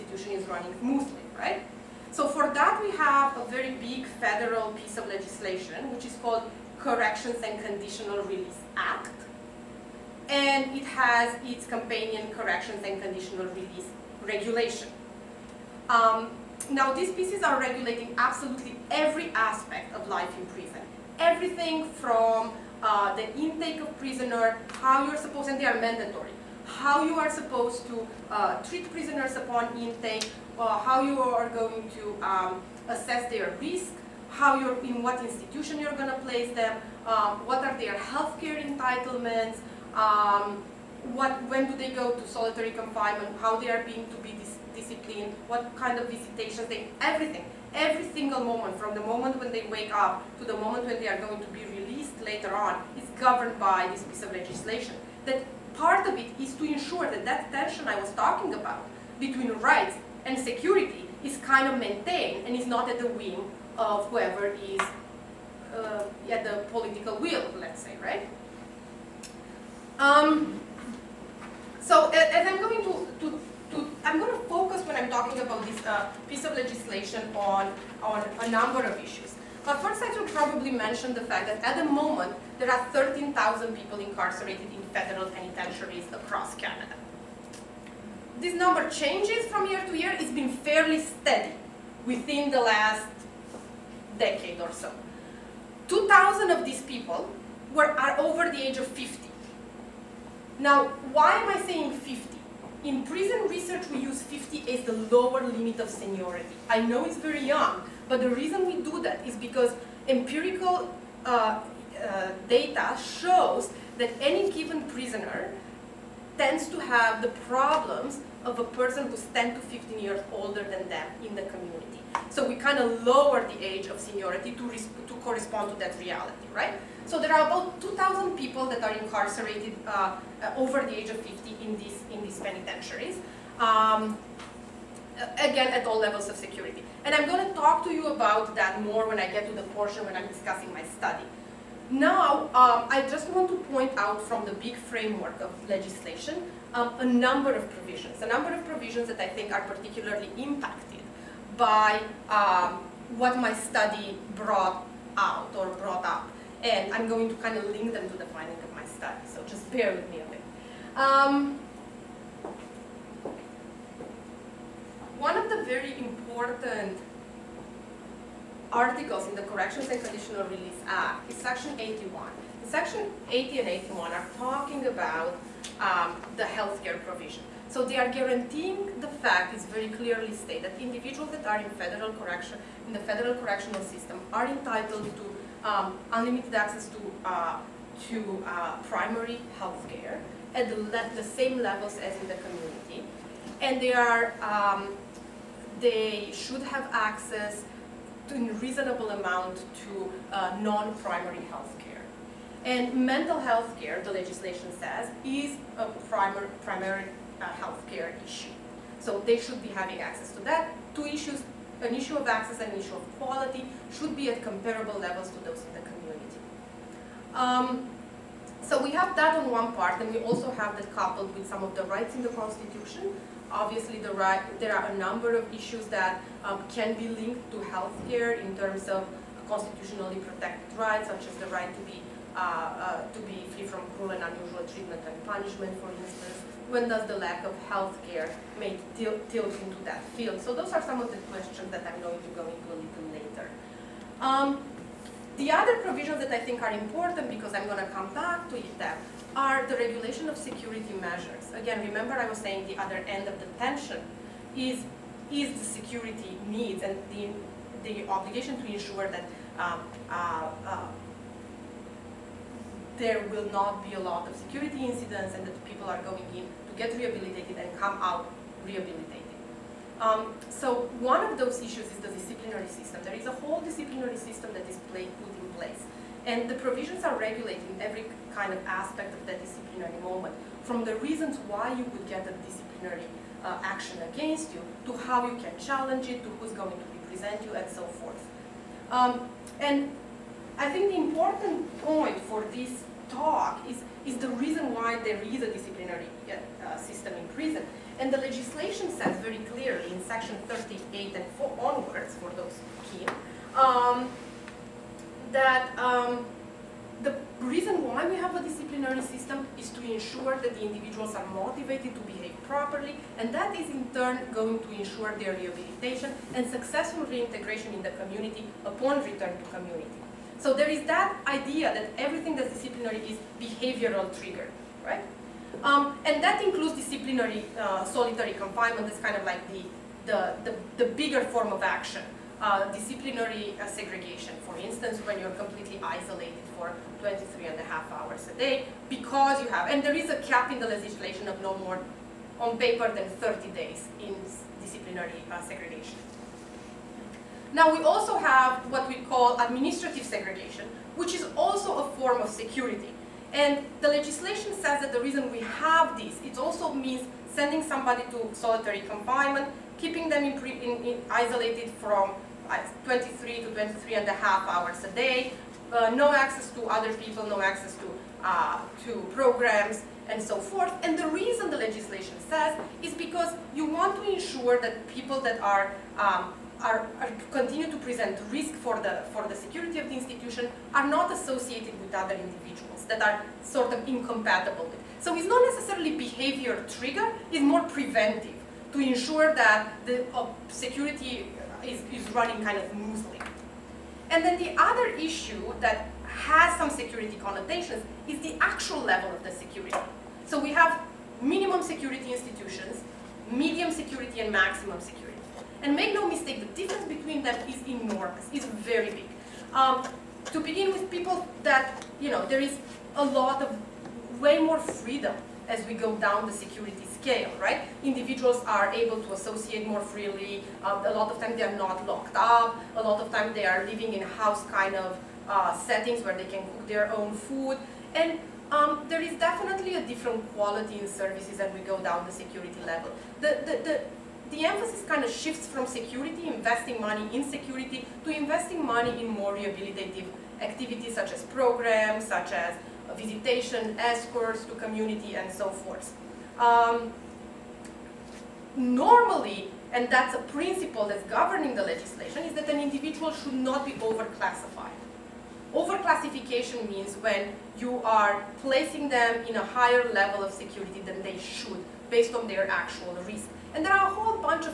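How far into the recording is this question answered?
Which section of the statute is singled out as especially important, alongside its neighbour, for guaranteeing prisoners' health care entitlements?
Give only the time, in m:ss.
2:51.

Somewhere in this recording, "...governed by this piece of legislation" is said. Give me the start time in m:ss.
0:53.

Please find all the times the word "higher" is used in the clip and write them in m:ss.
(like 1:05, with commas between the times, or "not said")
7:39.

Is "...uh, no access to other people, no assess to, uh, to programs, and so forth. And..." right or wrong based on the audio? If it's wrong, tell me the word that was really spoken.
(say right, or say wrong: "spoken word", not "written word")
wrong: "access", not "assess".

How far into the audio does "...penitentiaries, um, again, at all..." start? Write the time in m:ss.
2:12.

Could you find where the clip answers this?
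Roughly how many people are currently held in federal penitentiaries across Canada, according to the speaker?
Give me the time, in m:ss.
1:22.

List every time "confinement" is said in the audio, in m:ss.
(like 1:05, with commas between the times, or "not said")
0:42, 5:28, 5:58.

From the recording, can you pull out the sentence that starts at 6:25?
So it's not necessarily behavior trigger, it's more preventive to ensure that the uh, security is, is running kind of smoothly.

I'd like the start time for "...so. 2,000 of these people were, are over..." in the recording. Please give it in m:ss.
1:34.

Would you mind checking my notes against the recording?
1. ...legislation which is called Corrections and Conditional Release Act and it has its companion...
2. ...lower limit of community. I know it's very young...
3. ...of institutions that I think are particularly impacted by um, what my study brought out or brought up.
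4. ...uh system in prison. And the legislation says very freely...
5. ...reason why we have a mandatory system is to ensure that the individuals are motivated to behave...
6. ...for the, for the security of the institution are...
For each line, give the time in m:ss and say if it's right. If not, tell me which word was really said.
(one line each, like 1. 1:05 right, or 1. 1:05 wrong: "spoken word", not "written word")
1. 0:05 right
2. 1:44 wrong: "seniority", not "community"
3. 2:28 wrong: "provisions", not "institutions"
4. 4:56 wrong: "clearly", not "freely"
5. 5:07 wrong: "disciplinary", not "mandatory"
6. 6:18 right.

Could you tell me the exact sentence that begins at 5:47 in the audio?
Now we also have what we call administrative segregation, which is also a form of security.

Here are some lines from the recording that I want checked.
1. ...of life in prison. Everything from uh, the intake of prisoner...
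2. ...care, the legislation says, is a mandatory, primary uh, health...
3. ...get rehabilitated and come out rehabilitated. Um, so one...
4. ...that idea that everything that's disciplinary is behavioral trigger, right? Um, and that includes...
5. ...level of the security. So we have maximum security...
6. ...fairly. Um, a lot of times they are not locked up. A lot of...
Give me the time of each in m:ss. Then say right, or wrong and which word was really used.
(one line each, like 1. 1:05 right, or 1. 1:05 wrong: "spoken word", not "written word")
1. 0:19 right
2. 3:23 wrong: "primary", not "mandatory"
3. 4:26 right
4. 5:20 right
5. 6:38 wrong: "minimum", not "maximum"
6. 6:59 wrong: "freely", not "fairly".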